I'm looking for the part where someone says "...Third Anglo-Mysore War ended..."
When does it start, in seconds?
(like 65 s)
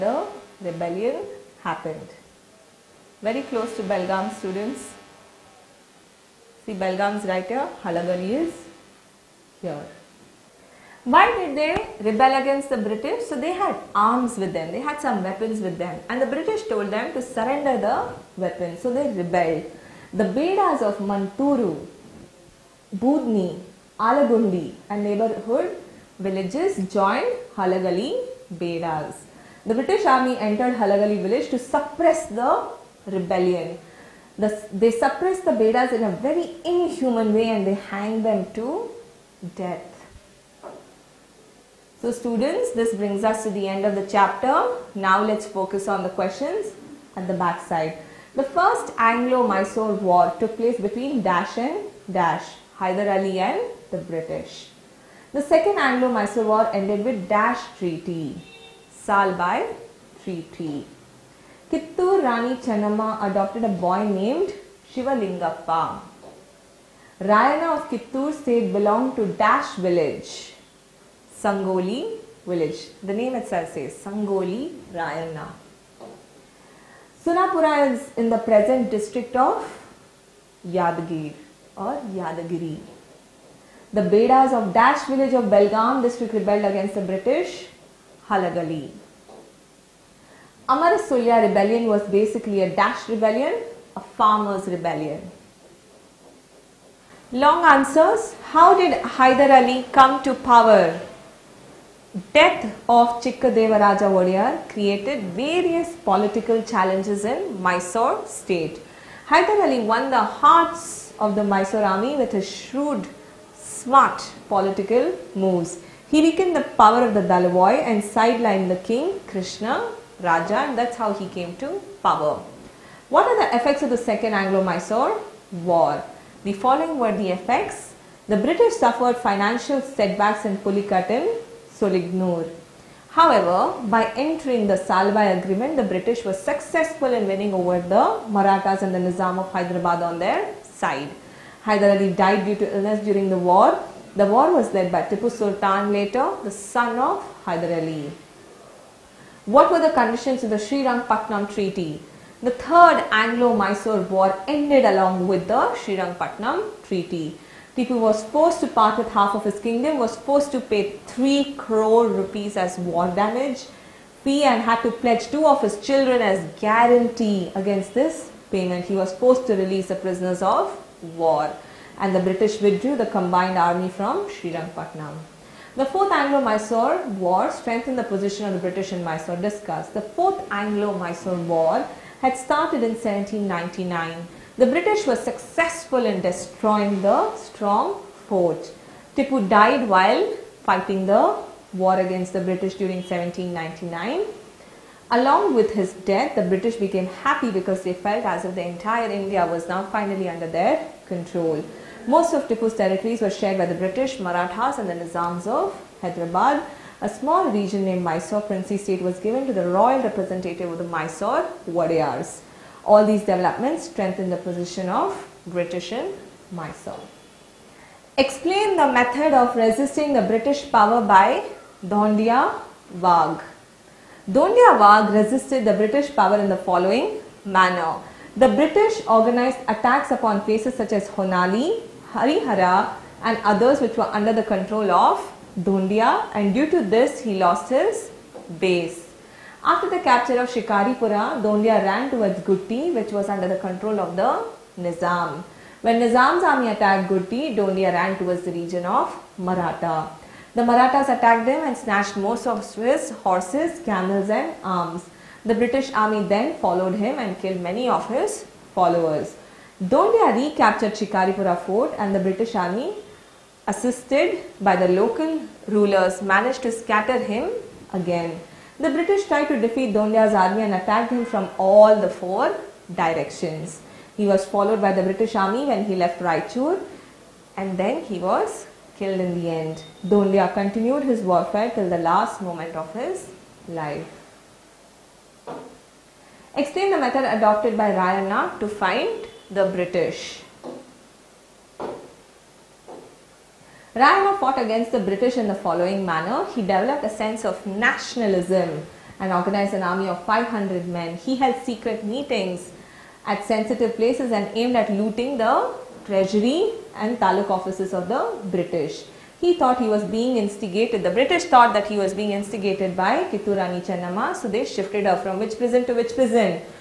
152 s.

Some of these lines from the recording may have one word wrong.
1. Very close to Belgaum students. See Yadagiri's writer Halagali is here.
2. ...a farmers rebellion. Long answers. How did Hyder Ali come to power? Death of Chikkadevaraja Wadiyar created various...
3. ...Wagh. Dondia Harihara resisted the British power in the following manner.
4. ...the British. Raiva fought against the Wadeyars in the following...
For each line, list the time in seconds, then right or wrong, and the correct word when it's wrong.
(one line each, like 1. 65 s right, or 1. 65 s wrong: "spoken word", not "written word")
1. 3 s wrong: "Belgaum", not "Yadagiri"
2. 93 s right
3. 222 s wrong: "Wagh", not "Harihara"
4. 289 s wrong: "British", not "Wadeyars".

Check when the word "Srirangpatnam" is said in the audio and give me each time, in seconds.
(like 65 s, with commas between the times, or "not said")
150 s, 155 s, 174 s.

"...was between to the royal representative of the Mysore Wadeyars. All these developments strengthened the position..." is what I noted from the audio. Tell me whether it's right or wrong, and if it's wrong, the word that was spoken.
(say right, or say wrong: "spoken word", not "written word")
wrong: "given", not "between".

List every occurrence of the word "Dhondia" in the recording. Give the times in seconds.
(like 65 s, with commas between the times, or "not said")
241 s, 247 s.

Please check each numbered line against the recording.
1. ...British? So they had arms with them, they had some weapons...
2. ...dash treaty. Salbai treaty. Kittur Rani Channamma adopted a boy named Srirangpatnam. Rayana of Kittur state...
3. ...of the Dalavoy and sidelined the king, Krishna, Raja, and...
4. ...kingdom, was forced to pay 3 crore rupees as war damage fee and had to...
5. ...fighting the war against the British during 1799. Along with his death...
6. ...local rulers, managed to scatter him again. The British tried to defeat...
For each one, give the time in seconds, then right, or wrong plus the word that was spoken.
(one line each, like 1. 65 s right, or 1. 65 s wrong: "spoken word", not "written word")
1. 12 s right
2. 57 s wrong: "Shivalingappa", not "Srirangpatnam"
3. 117 s right
4. 159 s right
5. 190 s right
6. 264 s right.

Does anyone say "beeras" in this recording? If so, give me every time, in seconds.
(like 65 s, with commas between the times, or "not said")
20 s, 28 s.